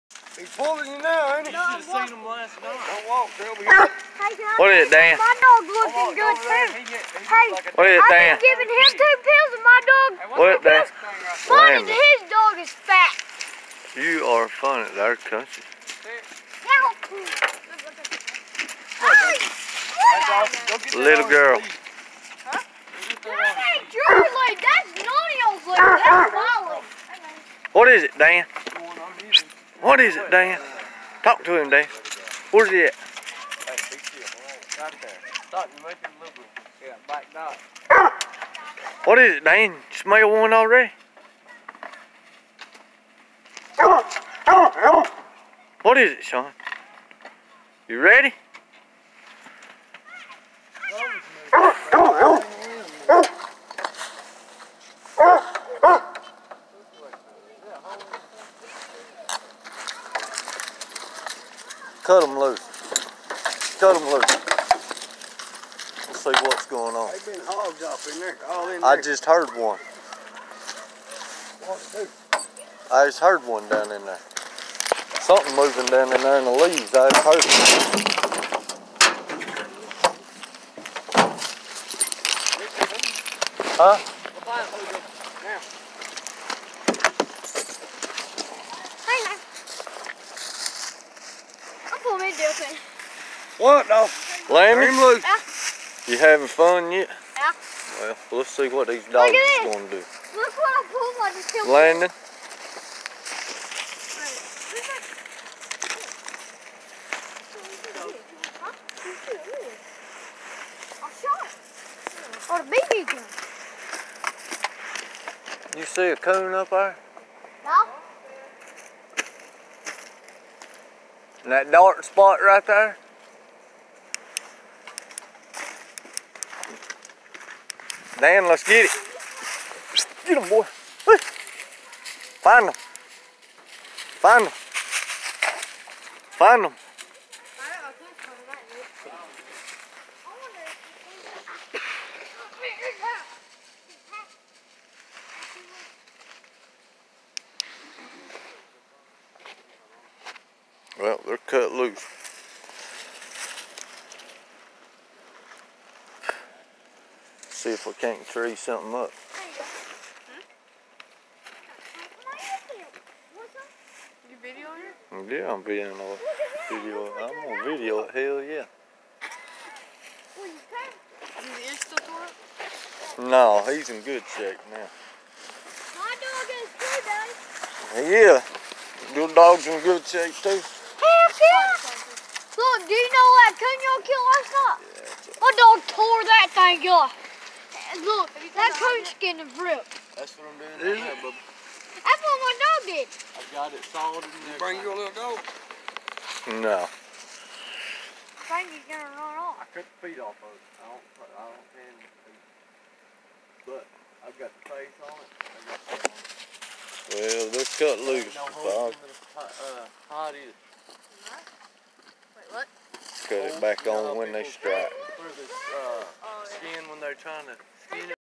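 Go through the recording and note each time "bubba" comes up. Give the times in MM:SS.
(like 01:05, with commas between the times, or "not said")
03:11.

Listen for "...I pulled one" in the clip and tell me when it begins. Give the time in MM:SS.
01:40.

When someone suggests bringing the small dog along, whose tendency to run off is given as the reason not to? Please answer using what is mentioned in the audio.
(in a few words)
Franky.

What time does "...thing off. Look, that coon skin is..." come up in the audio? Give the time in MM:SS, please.
03:06.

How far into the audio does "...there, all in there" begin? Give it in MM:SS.
01:07.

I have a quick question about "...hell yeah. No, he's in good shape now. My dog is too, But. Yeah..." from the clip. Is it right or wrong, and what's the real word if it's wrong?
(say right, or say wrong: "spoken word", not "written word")
wrong: "Daddy", not "But".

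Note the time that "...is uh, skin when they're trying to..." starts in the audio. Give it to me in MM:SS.
03:35.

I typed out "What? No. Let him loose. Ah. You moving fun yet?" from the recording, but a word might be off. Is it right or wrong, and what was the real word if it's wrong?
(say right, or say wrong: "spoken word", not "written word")
wrong: "having", not "moving".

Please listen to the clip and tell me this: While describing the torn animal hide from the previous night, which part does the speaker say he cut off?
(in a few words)
the feet.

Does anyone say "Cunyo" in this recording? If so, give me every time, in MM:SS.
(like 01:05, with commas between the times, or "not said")
03:03.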